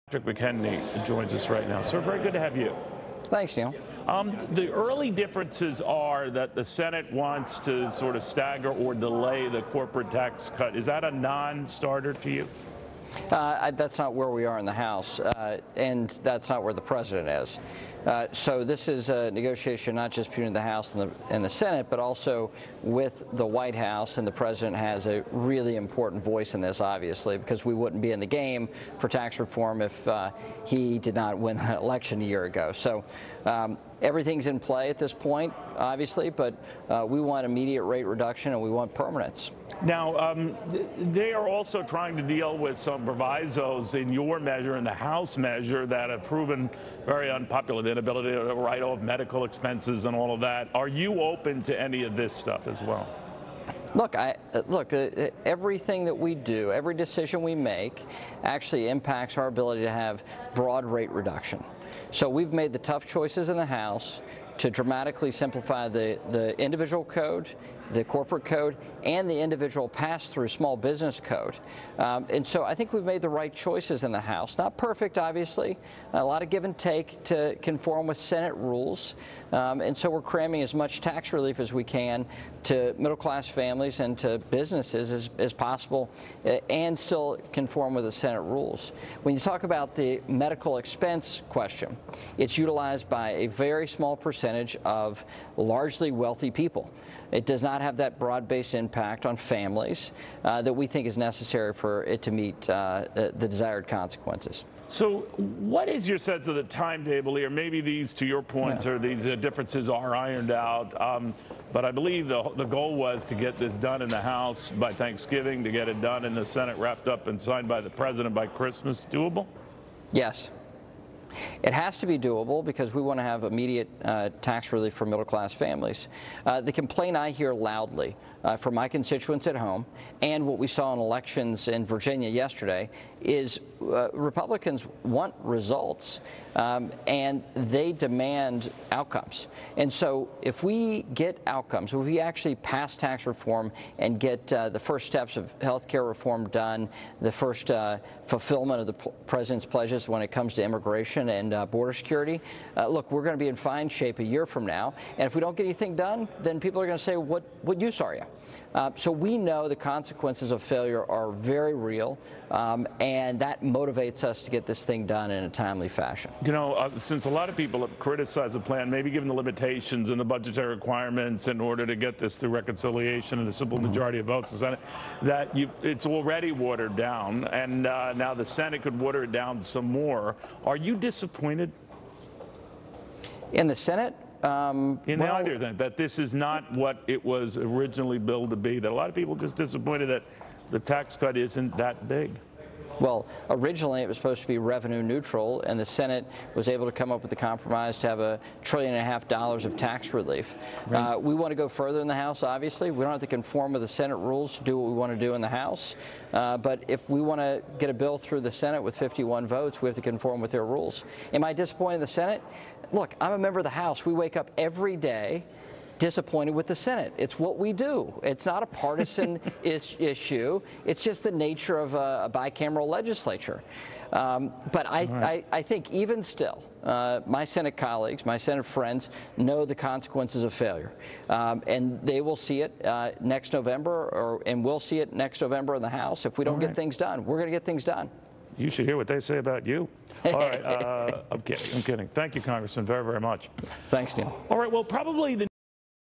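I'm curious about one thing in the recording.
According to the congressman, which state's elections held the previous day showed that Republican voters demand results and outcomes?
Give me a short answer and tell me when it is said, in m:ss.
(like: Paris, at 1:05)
Virginia, at 2:11.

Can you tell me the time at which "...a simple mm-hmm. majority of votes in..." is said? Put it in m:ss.
2:53.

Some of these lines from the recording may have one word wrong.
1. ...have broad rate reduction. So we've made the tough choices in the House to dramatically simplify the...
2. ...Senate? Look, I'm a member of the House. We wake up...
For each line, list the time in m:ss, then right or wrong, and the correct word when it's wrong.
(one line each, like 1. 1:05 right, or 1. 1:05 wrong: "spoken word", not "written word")
1. 0:59 right
2. 3:32 right.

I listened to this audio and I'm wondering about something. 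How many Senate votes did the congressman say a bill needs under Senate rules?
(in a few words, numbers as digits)
51.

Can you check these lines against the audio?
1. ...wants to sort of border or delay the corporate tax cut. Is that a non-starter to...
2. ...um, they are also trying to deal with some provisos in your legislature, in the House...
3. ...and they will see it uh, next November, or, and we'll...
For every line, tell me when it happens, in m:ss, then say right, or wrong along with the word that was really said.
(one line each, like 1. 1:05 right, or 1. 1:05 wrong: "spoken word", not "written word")
1. 0:07 wrong: "stagger", not "border"
2. 0:40 wrong: "measure", not "legislature"
3. 3:51 right.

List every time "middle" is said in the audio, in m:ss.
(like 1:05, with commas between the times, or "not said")
1:22, 2:05.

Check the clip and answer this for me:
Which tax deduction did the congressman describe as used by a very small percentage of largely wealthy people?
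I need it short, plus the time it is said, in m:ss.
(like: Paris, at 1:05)
Medical expenses, at 1:30.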